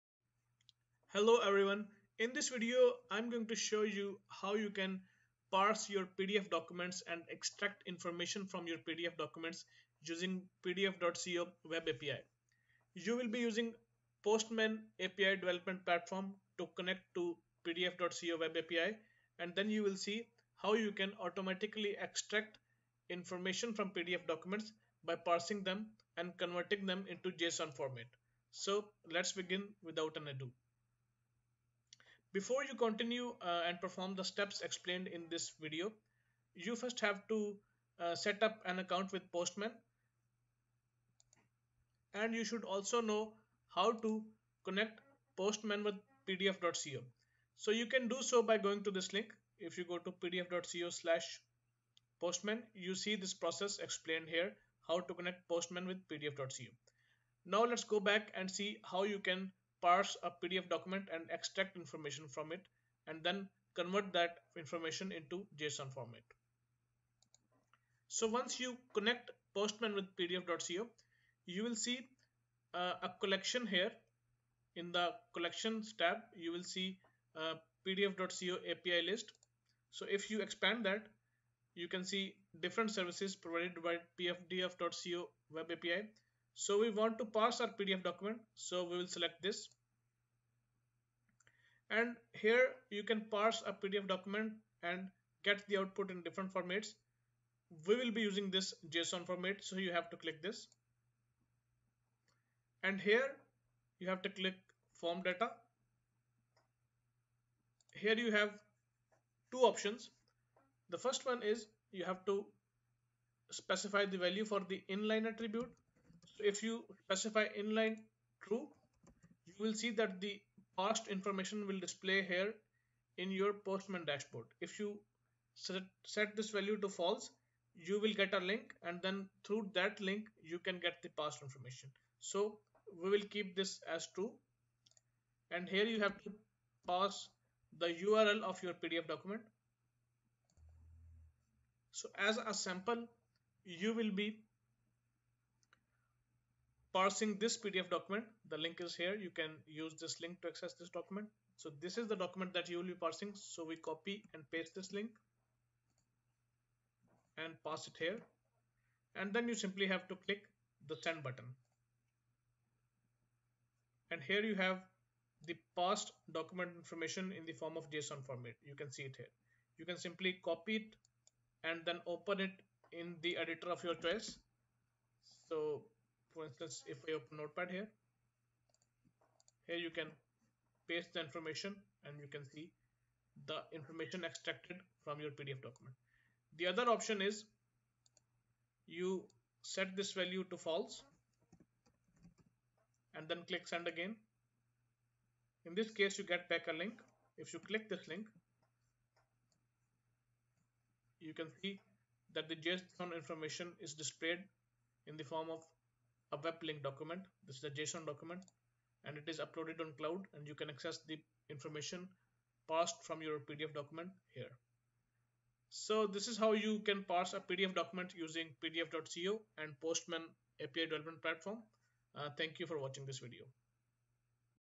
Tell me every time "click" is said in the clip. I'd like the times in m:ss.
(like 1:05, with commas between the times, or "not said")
1:40, 1:44, 2:40, 3:13, 3:17.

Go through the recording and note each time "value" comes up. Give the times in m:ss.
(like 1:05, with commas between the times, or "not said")
1:54, 2:06, 3:10.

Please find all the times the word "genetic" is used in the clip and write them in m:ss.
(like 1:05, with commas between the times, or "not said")
not said.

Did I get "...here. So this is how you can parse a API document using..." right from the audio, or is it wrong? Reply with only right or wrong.
wrong.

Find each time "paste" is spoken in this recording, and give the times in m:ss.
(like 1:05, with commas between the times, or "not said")
2:34, 3:00.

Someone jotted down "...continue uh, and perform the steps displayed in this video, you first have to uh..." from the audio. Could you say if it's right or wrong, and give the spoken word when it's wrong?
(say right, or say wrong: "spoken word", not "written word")
wrong: "explained", not "displayed".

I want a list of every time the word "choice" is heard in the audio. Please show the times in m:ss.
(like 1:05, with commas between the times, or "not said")
2:53.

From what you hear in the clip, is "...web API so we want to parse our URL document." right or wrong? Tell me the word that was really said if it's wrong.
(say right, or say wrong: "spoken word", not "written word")
wrong: "PDF", not "URL".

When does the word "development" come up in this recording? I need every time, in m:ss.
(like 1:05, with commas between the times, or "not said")
0:15, 3:40.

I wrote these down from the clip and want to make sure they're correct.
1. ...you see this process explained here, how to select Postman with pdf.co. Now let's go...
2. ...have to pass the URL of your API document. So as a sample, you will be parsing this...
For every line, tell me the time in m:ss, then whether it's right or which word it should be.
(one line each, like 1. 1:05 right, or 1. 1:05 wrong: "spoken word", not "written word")
1. 0:52 wrong: "connect", not "select"
2. 2:15 wrong: "PDF", not "API".